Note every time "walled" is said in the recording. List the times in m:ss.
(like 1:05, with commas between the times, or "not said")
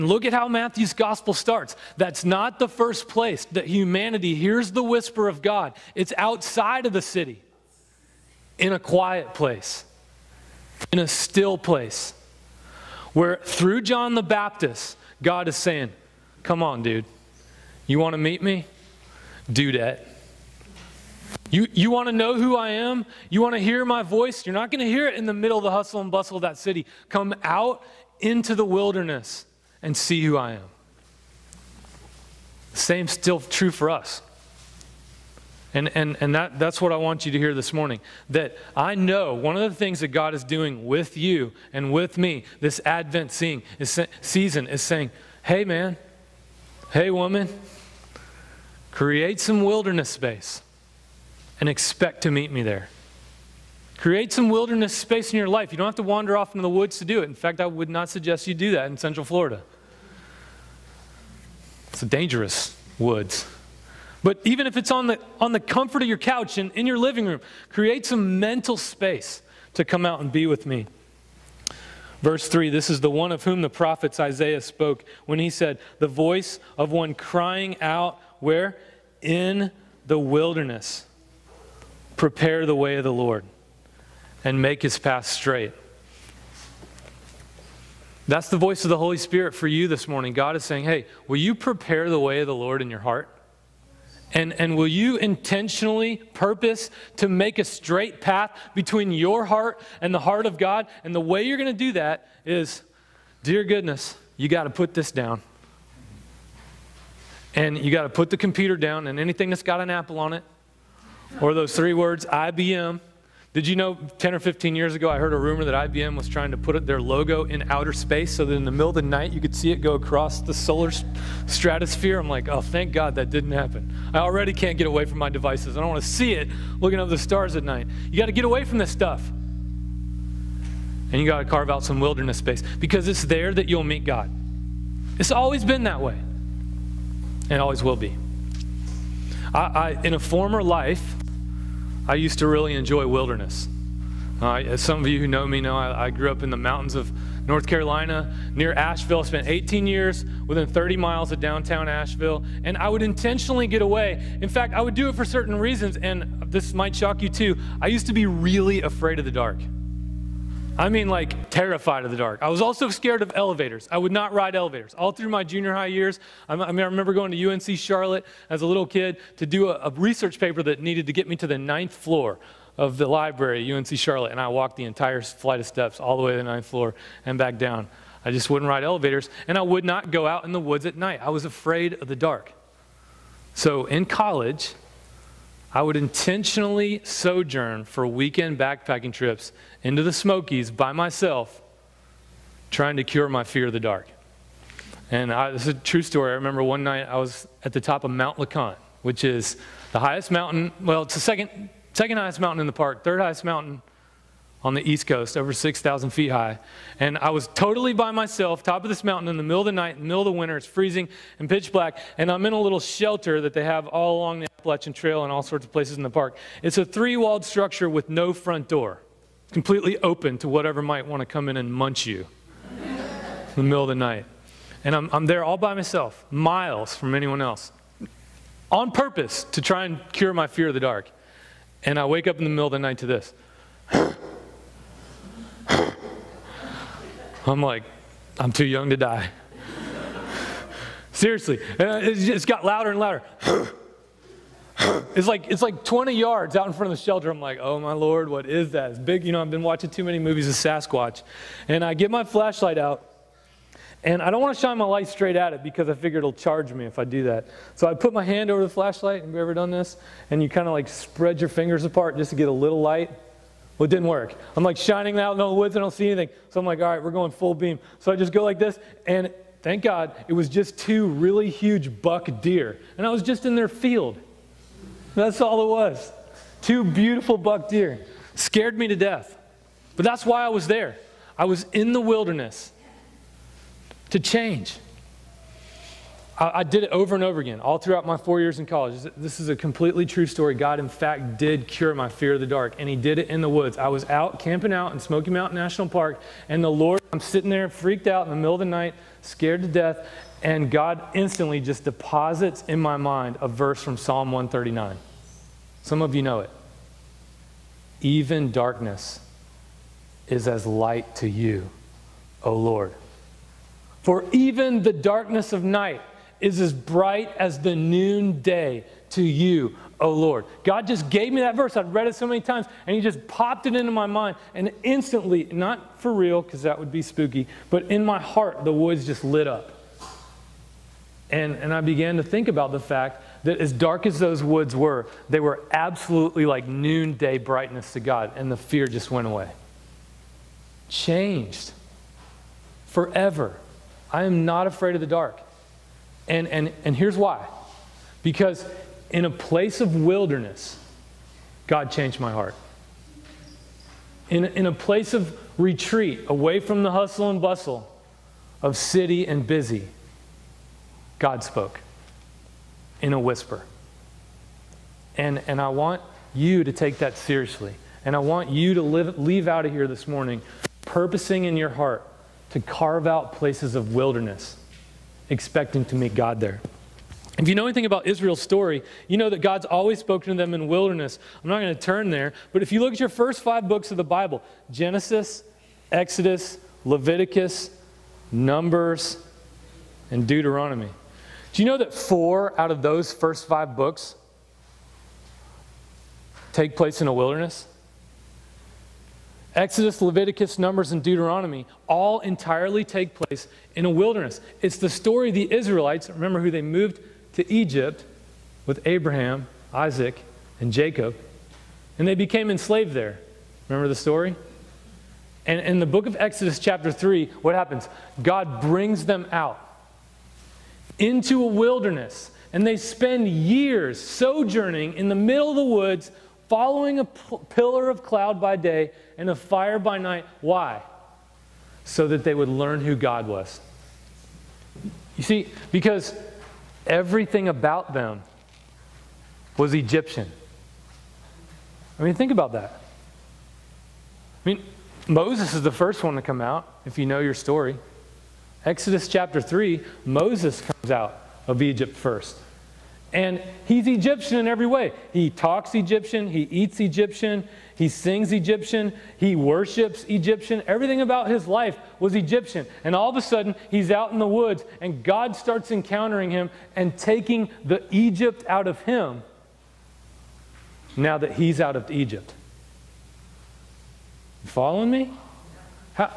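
3:37.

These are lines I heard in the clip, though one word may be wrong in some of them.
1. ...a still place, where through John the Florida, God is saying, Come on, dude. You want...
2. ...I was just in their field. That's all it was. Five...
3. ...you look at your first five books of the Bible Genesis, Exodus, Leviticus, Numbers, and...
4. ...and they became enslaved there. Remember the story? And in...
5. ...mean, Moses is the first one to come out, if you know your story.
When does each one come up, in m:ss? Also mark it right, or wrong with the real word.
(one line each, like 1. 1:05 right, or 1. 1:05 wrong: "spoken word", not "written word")
1. 0:10 wrong: "Baptist", not "Florida"
2. 4:33 wrong: "Two", not "Five"
3. 6:22 right
4. 6:51 right
5. 7:24 right.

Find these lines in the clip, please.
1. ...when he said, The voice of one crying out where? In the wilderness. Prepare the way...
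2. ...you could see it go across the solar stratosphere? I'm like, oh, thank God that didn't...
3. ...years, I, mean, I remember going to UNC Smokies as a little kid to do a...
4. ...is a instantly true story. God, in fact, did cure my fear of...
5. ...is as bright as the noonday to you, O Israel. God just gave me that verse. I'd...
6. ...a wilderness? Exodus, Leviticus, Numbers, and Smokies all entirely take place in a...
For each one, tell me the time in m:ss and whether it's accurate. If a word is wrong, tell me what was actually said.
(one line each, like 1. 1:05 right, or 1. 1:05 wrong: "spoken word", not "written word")
1. 1:15 right
2. 1:59 right
3. 2:45 wrong: "Charlotte", not "Smokies"
4. 4:49 wrong: "completely", not "instantly"
5. 5:16 wrong: "Lord", not "Israel"
6. 6:37 wrong: "Deuteronomy", not "Smokies".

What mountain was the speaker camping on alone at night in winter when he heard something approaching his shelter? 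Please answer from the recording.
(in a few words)
Mount Le Conte.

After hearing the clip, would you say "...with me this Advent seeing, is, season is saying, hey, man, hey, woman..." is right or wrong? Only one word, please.
right.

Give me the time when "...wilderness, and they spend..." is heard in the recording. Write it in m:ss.
7:01.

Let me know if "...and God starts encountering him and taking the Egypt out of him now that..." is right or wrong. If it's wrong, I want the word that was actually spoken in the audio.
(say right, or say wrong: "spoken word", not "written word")
right.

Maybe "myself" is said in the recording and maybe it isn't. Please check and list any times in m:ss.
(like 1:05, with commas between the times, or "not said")
3:10, 3:28, 3:45.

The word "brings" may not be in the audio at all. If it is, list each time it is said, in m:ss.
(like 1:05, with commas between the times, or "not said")
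6:58.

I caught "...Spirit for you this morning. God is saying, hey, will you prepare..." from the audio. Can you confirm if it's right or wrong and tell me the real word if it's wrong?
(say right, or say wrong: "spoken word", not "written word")
right.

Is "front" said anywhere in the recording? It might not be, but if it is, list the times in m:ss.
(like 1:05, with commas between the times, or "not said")
3:38, 4:06.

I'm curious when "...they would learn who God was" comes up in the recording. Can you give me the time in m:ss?
7:12.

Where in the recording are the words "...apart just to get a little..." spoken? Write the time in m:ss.
4:21.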